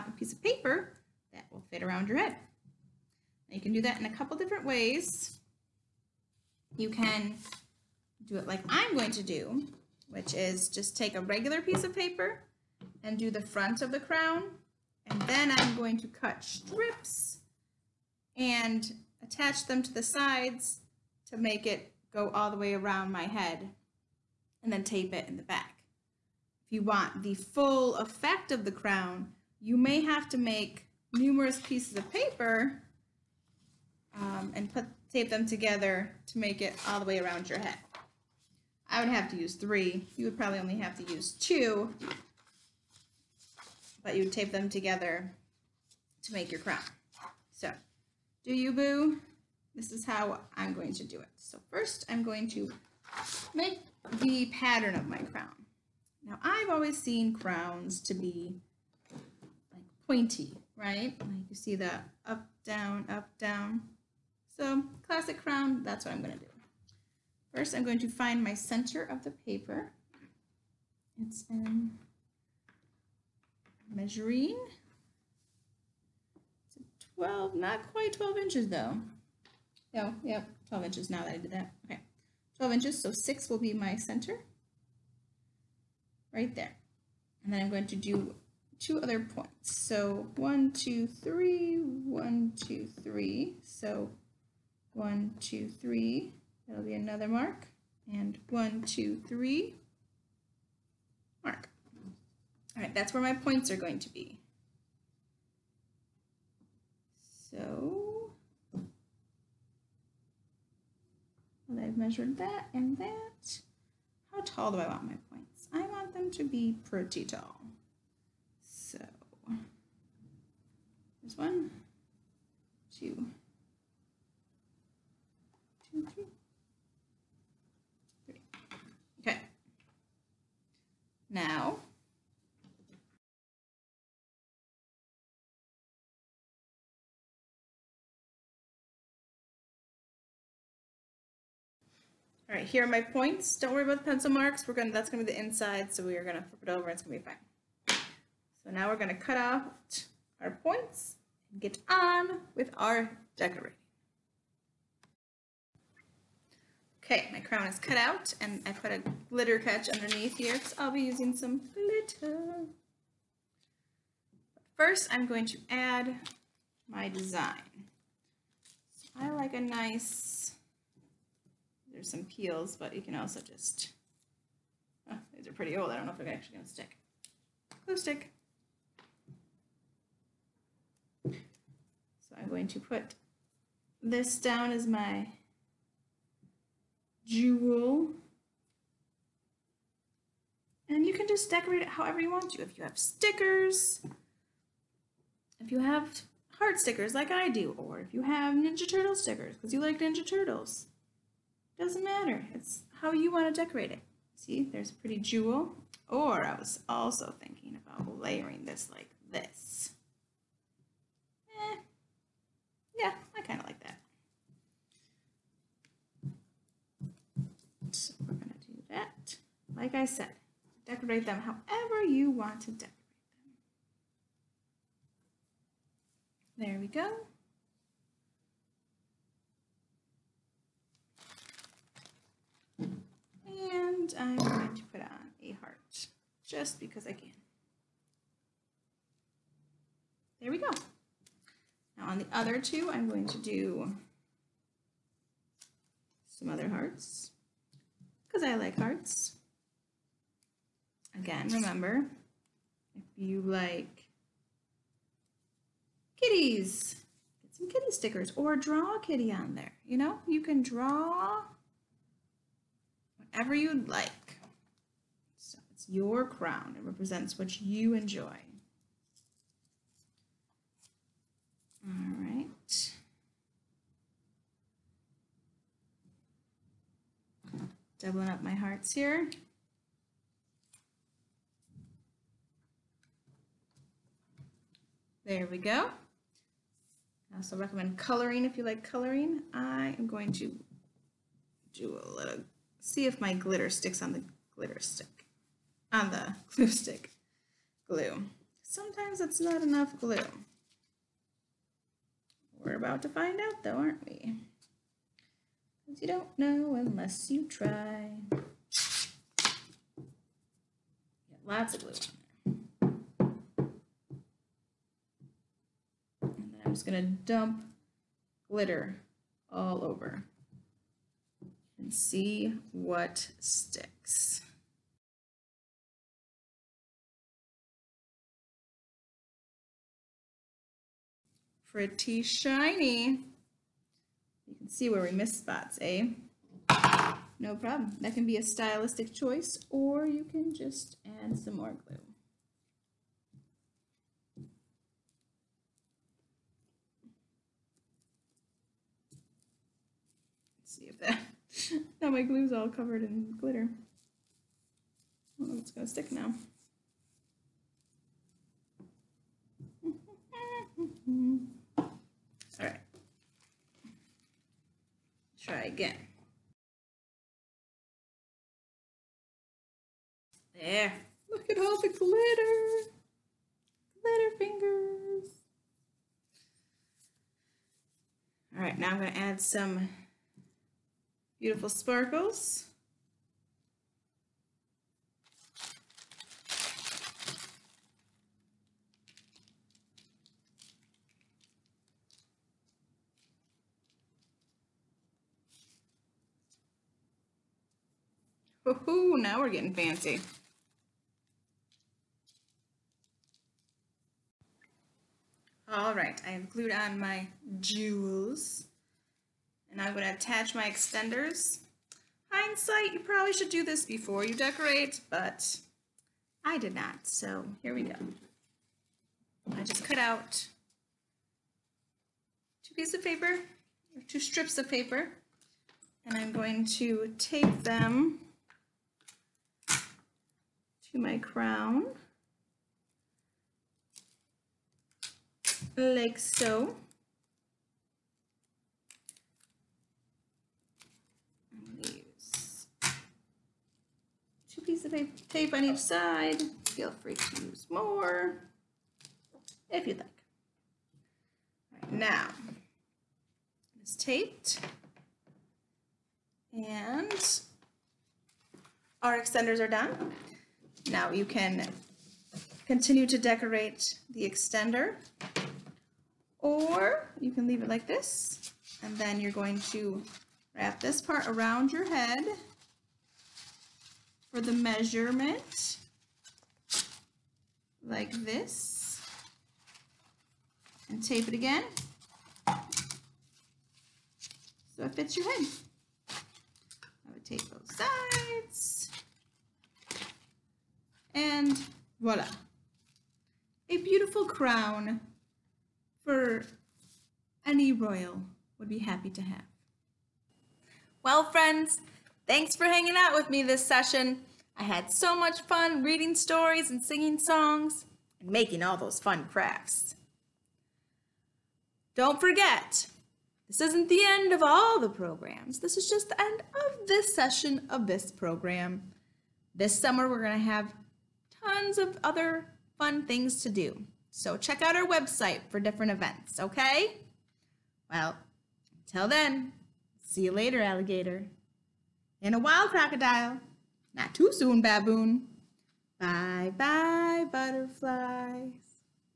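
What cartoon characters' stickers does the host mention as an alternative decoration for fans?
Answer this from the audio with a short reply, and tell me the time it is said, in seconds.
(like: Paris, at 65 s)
Ninja Turtles, at 198 s.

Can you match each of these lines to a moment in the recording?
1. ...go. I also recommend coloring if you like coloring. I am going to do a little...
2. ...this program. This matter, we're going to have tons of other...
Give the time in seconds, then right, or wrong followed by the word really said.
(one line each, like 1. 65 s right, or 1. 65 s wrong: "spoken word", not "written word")
1. 285 s right
2. 517 s wrong: "summer", not "matter".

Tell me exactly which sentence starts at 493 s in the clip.
A beautiful crown for any royal would be happy to have.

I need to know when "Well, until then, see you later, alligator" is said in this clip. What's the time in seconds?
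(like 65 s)
527 s.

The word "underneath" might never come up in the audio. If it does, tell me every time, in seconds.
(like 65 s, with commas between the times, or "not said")
159 s.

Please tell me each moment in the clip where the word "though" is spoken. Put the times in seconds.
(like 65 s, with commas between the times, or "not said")
78 s, 303 s.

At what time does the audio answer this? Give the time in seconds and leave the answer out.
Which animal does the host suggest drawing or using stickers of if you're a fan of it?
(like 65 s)
257 s.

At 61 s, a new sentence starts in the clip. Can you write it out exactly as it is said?
Like you see that up, down, up, down.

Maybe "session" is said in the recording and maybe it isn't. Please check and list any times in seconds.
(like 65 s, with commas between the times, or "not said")
503 s, 517 s.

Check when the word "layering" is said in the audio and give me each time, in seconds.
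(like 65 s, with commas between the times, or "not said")
208 s.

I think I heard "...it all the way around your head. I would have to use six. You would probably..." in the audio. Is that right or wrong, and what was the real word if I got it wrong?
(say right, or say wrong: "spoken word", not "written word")
wrong: "three", not "six".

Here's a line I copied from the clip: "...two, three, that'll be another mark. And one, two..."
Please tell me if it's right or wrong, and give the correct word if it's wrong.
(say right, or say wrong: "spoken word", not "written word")
right.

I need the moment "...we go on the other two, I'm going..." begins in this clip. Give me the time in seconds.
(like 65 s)
240 s.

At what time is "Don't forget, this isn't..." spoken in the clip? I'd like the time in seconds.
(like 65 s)
511 s.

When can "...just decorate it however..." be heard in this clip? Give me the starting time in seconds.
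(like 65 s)
191 s.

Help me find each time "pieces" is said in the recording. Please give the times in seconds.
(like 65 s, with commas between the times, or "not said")
0 s, 11 s, 31 s, 422 s, 444 s.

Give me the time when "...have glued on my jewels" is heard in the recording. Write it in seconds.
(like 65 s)
406 s.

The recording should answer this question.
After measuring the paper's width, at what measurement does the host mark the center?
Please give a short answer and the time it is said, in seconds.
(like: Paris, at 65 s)
6, at 83 s.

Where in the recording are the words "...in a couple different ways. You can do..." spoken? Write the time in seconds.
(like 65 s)
3 s.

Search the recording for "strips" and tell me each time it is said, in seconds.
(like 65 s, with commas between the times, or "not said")
16 s, 424 s.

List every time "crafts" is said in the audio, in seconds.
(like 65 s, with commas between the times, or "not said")
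509 s.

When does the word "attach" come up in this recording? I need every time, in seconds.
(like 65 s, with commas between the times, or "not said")
19 s, 410 s.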